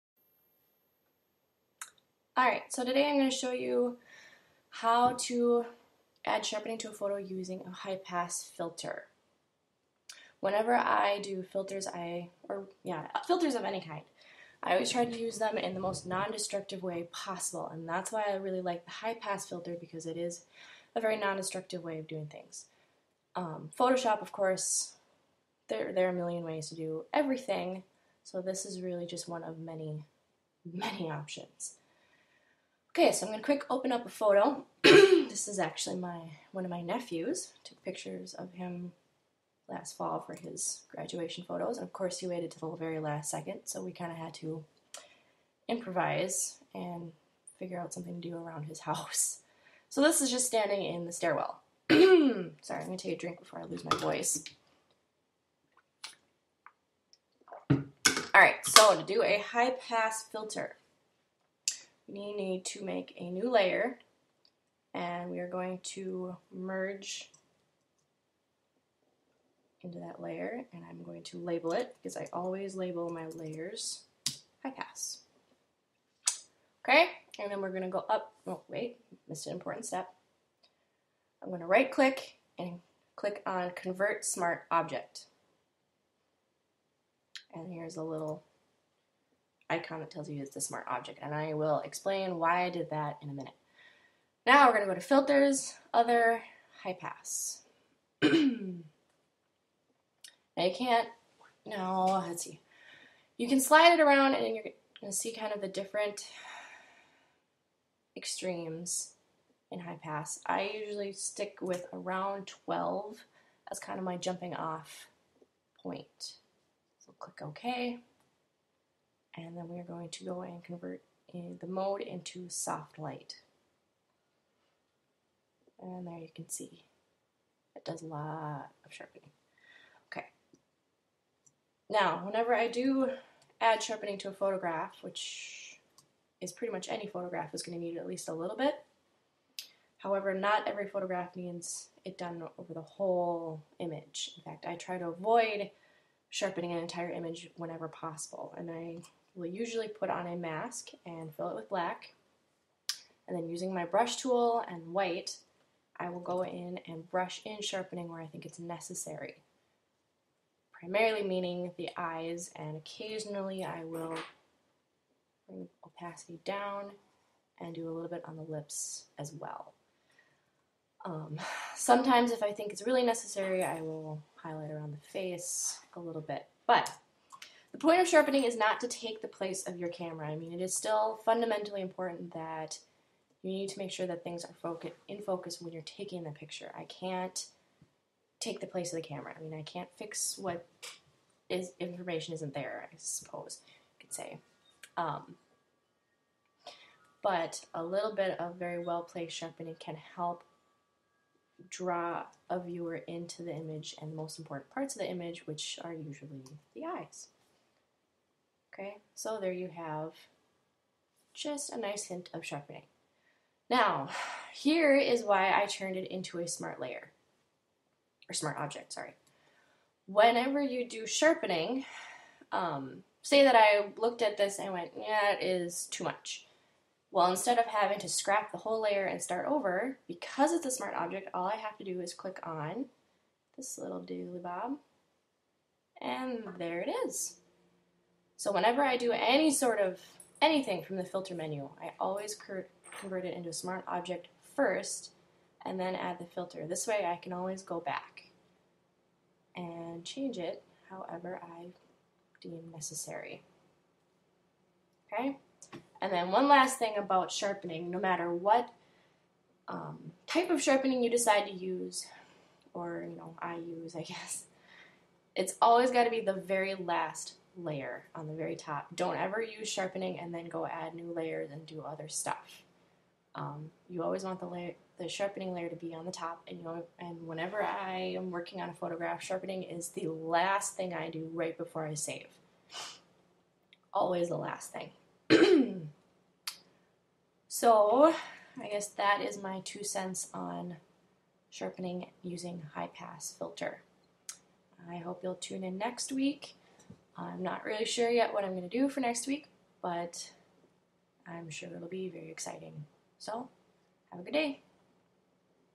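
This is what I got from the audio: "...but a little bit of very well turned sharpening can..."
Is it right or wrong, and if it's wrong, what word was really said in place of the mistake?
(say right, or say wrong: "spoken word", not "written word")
wrong: "placed", not "turned".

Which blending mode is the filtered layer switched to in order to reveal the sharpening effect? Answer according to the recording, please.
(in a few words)
Soft light.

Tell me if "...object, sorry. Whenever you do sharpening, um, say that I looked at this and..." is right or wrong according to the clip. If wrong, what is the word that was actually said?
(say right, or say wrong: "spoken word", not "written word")
right.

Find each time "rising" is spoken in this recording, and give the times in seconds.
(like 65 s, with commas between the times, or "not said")
not said.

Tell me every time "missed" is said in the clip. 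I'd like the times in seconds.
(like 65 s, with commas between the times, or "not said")
79 s.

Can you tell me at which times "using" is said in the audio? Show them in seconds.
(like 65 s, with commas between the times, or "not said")
7 s, 153 s, 292 s.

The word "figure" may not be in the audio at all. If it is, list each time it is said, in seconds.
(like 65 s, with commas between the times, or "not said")
47 s.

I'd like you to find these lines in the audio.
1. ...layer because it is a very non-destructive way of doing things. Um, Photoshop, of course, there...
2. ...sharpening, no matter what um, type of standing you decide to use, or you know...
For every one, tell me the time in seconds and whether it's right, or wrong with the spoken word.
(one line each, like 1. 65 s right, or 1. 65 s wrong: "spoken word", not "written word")
1. 19 s wrong: "filter", not "layer"
2. 257 s wrong: "sharpening", not "standing".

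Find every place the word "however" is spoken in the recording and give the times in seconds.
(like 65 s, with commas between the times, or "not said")
139 s, 250 s.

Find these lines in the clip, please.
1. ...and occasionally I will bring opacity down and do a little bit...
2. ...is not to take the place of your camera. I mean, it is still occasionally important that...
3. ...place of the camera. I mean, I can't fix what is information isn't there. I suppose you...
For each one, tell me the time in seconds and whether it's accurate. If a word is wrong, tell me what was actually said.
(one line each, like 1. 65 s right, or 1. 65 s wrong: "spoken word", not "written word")
1. 162 s right
2. 178 s wrong: "fundamentally", not "occasionally"
3. 188 s right.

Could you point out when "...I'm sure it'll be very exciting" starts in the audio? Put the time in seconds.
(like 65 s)
301 s.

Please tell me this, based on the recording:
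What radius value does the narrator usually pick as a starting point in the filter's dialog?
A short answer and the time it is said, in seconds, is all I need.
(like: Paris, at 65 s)
12, at 112 s.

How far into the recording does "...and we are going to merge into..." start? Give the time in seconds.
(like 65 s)
64 s.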